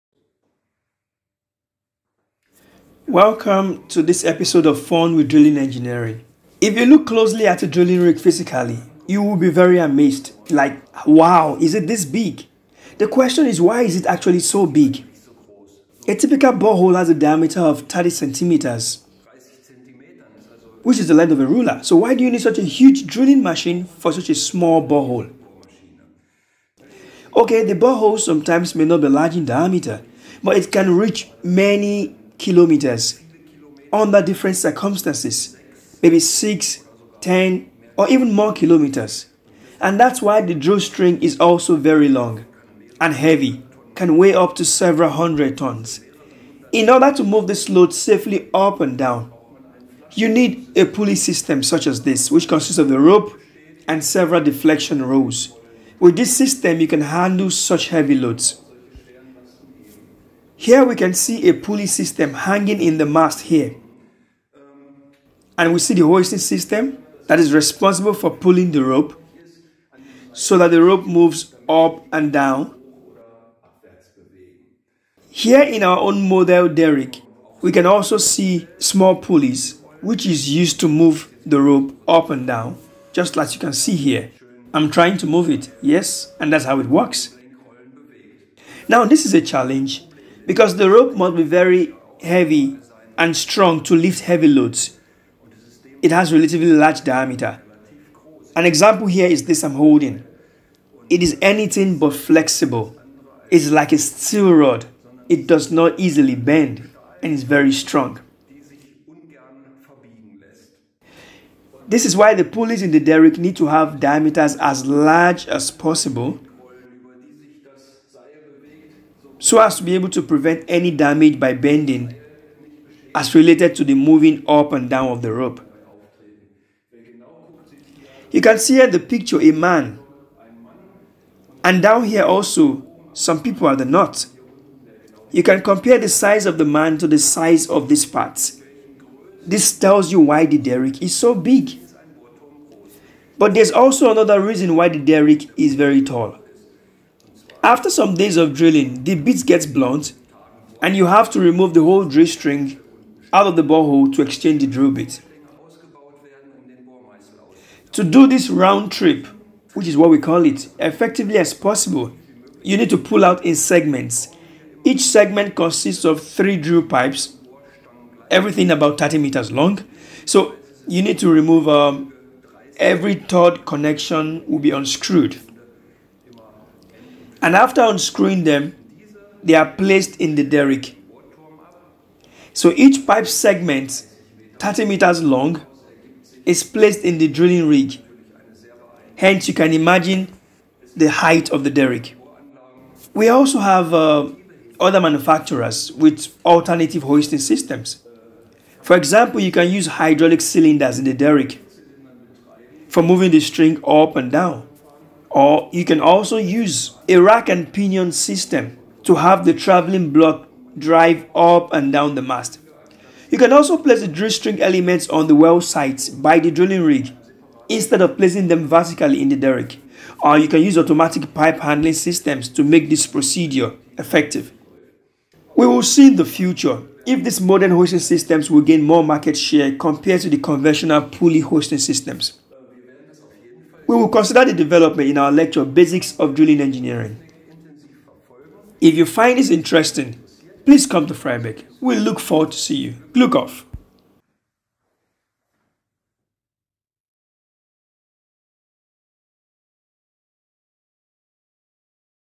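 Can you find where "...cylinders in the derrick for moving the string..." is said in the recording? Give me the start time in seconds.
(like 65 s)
200 s.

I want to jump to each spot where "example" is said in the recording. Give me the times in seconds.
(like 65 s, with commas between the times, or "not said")
98 s, 198 s.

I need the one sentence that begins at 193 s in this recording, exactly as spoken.
We also have uh, other manufacturers with alternative hoisting systems.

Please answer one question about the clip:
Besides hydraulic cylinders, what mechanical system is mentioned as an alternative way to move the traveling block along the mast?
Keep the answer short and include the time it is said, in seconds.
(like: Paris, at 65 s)
rack and pinion, at 207 s.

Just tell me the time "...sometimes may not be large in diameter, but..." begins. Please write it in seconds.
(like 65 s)
28 s.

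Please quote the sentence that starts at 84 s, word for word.
I'm trying to move it, yes, and that's how it works.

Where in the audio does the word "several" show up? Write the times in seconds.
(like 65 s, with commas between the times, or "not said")
44 s, 54 s.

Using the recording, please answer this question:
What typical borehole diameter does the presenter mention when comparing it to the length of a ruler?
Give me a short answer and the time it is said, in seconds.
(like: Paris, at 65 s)
30 centimeters, at 17 s.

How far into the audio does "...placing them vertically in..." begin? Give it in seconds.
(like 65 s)
218 s.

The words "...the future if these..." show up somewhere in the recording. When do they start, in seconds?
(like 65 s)
226 s.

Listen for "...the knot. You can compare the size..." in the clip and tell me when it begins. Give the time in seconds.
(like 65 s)
133 s.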